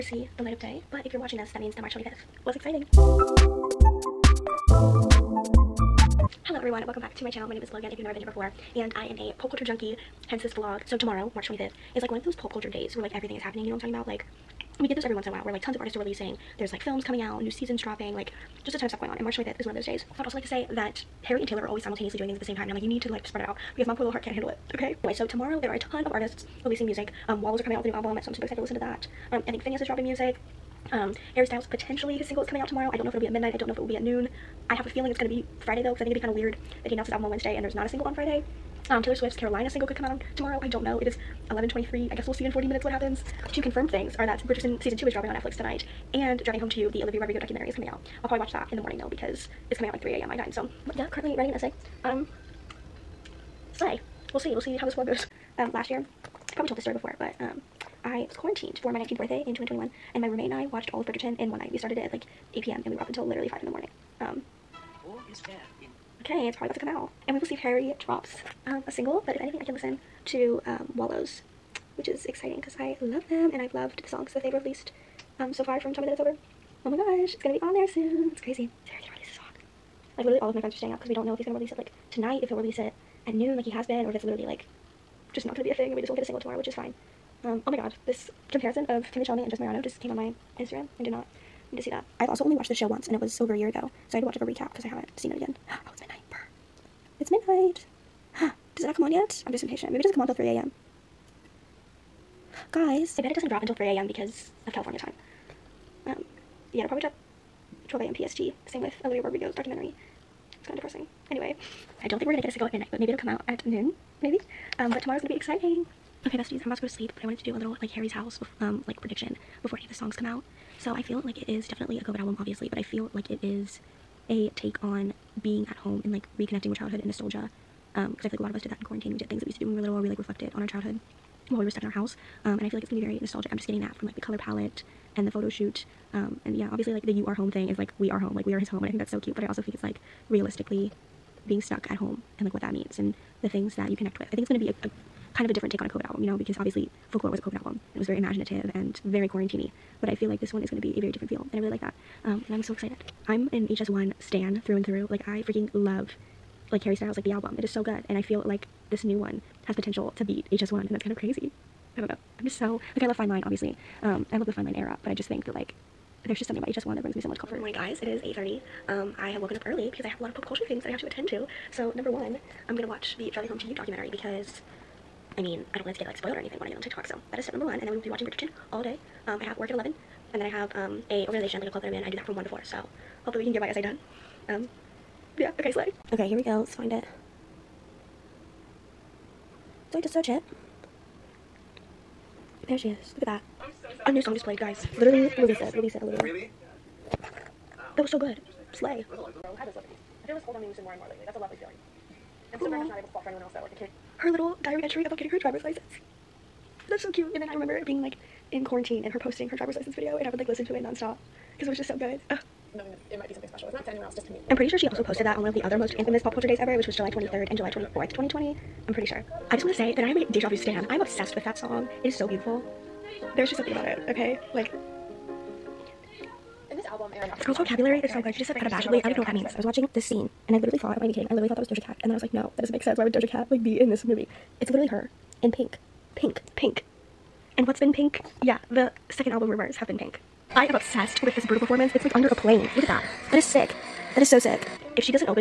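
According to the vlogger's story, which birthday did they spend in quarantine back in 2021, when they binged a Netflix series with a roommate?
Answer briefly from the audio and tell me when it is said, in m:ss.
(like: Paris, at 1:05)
19th, at 0:58.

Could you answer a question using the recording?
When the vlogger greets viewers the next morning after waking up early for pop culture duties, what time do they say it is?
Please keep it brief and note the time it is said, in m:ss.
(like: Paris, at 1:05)
8:30, at 2:48.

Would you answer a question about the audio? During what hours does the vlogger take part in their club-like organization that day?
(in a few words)
1 to 4.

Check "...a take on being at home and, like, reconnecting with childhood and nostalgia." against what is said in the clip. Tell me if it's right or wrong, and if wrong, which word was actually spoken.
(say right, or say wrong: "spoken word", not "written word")
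right.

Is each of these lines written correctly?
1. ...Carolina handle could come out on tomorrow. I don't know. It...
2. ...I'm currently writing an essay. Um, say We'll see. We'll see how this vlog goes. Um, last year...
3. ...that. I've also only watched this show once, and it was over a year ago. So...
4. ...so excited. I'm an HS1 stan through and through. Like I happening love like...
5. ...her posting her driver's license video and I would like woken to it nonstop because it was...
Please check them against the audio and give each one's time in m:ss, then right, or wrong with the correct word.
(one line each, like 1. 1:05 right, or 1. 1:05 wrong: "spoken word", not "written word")
1. 0:39 wrong: "single", not "handle"
2. 0:51 right
3. 1:31 right
4. 2:32 wrong: "freaking", not "happening"
5. 3:29 wrong: "listen", not "woken".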